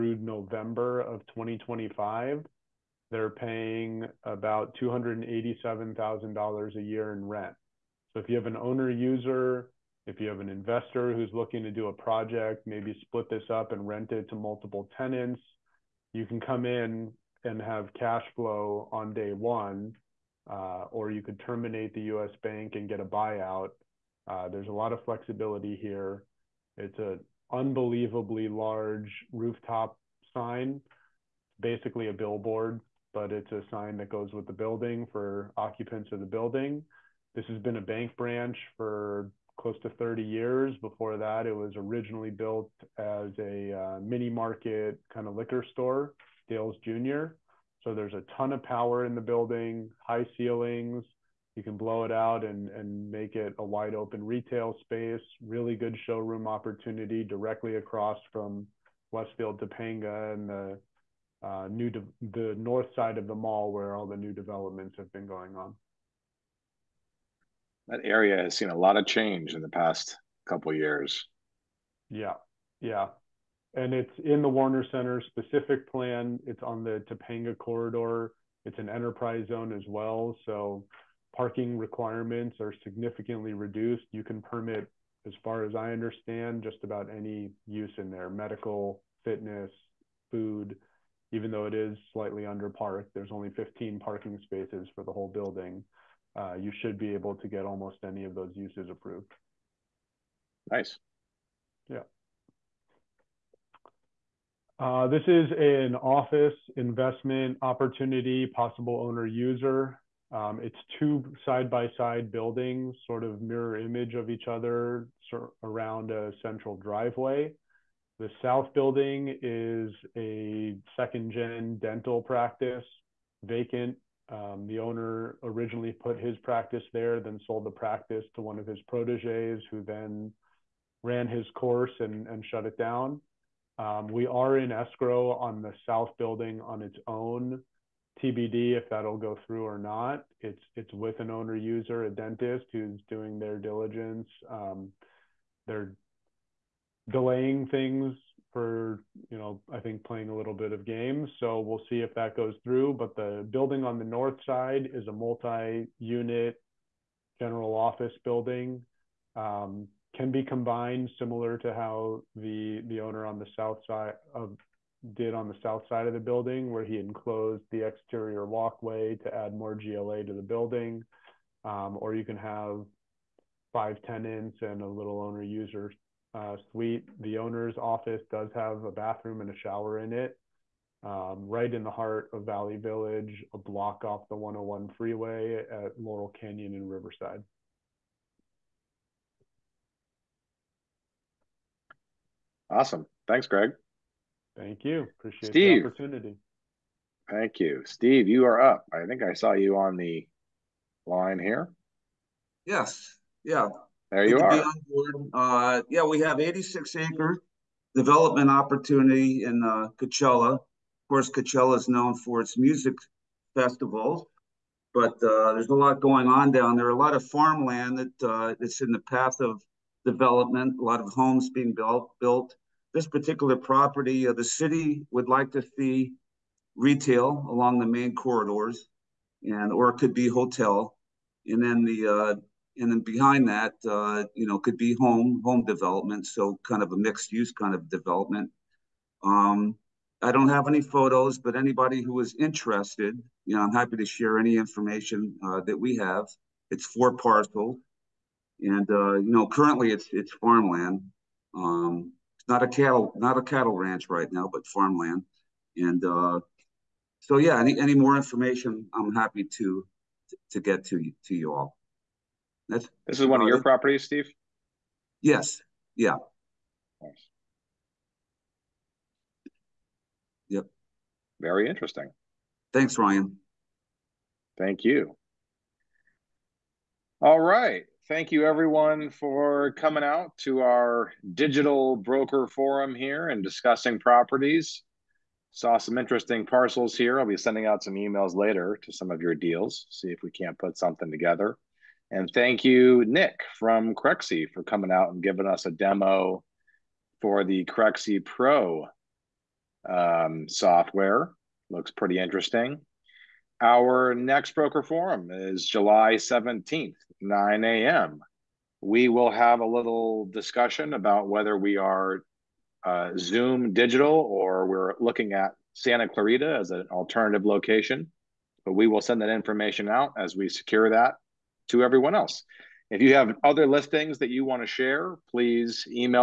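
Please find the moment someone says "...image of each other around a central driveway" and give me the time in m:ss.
1:53.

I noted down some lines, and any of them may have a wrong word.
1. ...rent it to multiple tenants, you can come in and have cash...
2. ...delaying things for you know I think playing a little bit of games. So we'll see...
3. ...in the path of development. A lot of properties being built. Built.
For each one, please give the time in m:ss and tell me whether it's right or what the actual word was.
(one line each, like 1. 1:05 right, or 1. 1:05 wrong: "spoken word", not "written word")
1. 0:13 right
2. 2:27 right
3. 3:38 wrong: "homes", not "properties".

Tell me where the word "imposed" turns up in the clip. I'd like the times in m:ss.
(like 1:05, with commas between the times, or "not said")
not said.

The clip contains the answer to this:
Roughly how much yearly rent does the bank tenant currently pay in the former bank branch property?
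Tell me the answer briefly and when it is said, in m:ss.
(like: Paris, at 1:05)
$287,000, at 0:04.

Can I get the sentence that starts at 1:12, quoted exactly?
Yeah, yeah, and it's in the Warner Center specific plan.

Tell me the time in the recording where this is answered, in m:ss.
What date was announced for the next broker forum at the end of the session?
5:05.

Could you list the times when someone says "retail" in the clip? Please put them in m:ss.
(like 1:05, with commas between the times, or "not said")
0:54, 3:46.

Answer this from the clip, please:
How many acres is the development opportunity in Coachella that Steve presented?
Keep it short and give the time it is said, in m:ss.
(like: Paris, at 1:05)
86, at 3:26.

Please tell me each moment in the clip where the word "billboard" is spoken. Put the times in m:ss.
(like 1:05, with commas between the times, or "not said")
0:32.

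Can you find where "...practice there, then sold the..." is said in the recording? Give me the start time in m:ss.
2:06.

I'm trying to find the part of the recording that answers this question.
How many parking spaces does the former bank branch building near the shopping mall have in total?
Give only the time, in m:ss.
1:33.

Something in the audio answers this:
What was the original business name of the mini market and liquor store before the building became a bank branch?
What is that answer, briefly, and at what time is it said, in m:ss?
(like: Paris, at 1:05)
Dale's Jr., at 0:46.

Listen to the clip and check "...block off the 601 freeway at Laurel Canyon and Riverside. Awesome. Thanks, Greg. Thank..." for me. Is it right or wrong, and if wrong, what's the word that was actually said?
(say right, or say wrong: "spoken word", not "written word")
wrong: "101", not "601".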